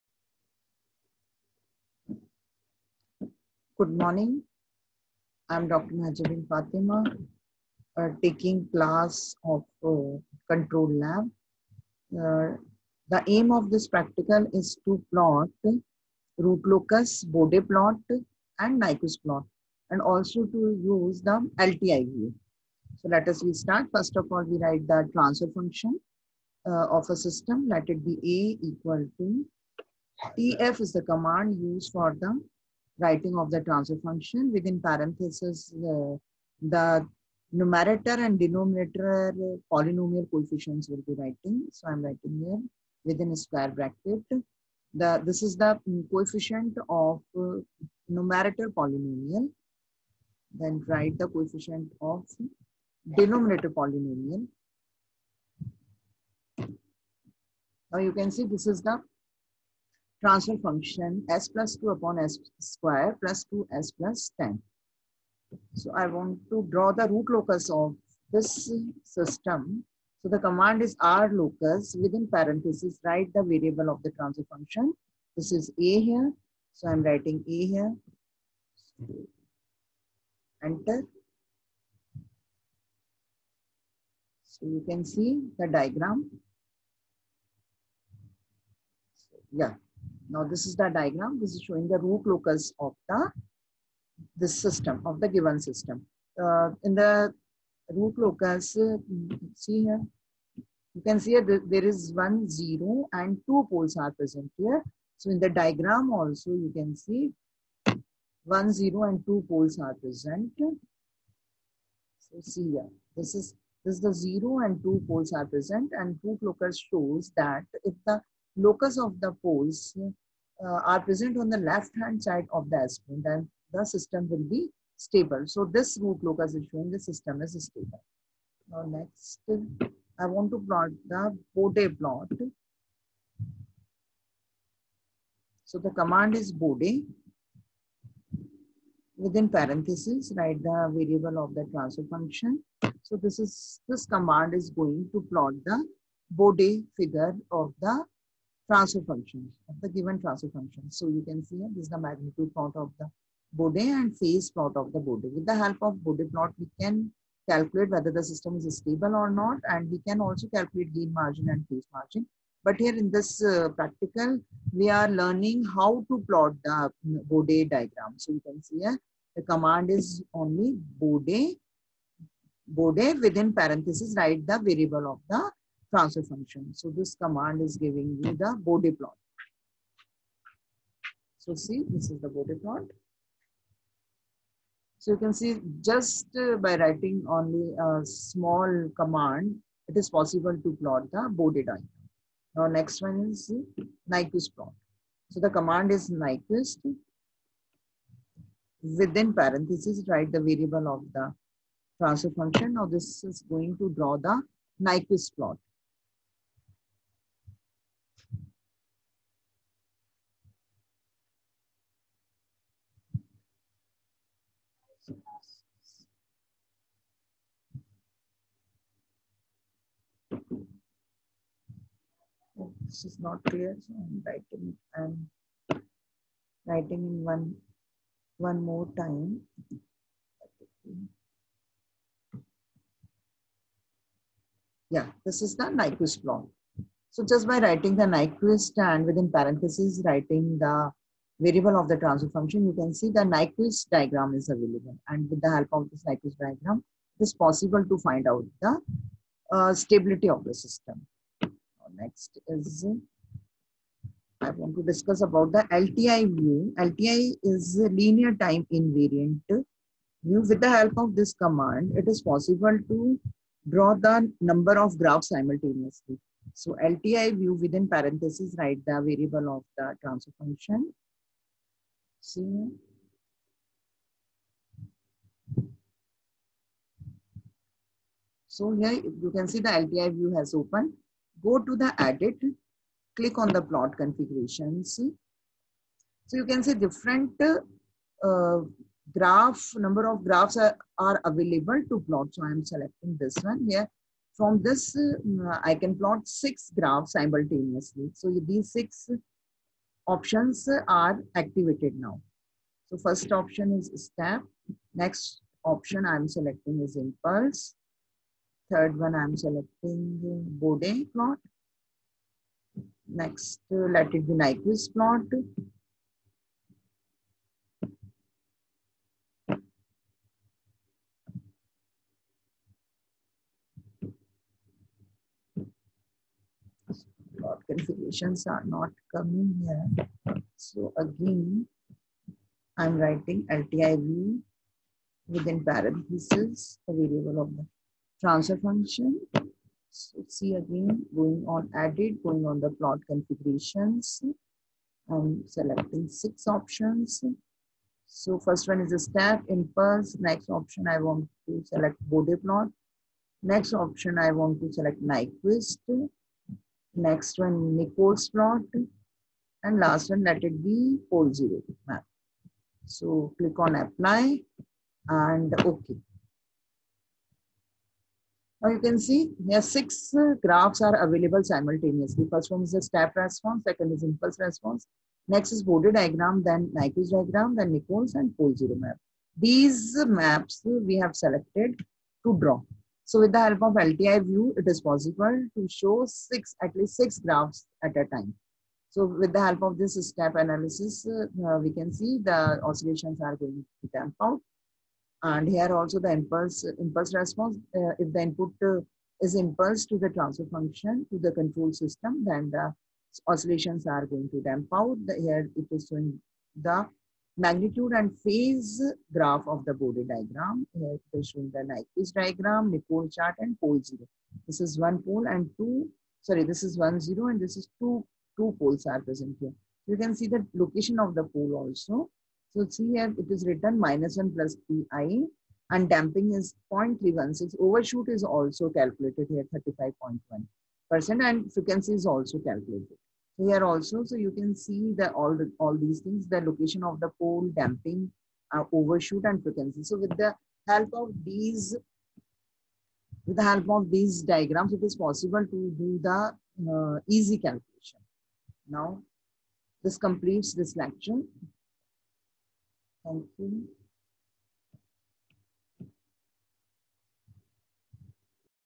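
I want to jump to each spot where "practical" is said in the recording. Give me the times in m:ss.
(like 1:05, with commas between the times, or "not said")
0:13, 2:43.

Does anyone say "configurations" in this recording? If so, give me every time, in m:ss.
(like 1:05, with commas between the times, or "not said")
4:43, 5:27, 5:43.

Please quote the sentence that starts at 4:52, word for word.
So I'm selecting this one here.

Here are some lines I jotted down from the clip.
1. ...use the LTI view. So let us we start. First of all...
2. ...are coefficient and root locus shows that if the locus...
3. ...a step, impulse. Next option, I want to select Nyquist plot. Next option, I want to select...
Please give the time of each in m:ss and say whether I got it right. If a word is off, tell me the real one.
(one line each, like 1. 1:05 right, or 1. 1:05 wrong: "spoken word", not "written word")
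1. 0:20 right
2. 1:55 wrong: "present", not "coefficient"
3. 5:48 wrong: "Bode", not "Nyquist".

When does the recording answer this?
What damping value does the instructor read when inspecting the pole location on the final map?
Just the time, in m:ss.
7:06.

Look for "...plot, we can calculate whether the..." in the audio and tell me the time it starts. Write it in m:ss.
2:36.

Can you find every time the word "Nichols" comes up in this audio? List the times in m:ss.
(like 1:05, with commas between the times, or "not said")
5:57, 6:17, 6:52.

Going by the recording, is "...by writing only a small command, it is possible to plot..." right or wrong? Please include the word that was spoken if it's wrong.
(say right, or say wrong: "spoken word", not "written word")
right.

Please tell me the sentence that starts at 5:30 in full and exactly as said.
So again, I'm writing LTIV within parentheses, a variable of the transfer function.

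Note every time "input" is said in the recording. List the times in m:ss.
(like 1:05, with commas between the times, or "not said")
6:38.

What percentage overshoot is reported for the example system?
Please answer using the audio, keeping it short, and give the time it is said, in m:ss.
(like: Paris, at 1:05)
35.1%, at 7:09.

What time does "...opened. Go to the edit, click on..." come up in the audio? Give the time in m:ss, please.
4:40.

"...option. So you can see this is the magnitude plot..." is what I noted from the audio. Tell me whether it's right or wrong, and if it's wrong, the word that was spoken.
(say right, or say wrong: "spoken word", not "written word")
wrong: "function", not "option".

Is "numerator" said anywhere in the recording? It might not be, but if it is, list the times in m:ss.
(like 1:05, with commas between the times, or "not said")
0:37, 0:48.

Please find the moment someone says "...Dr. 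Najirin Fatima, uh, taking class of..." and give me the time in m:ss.
0:05.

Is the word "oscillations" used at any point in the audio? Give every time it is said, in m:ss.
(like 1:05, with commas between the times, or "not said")
6:32, 6:43.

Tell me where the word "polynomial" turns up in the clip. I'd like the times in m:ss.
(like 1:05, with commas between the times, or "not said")
0:39, 0:48, 0:53.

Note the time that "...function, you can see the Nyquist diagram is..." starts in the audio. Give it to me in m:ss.
4:02.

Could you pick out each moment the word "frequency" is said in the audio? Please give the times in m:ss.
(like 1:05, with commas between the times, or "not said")
7:11, 7:19.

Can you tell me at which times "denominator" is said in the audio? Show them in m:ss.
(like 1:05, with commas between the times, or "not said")
0:38, 0:53.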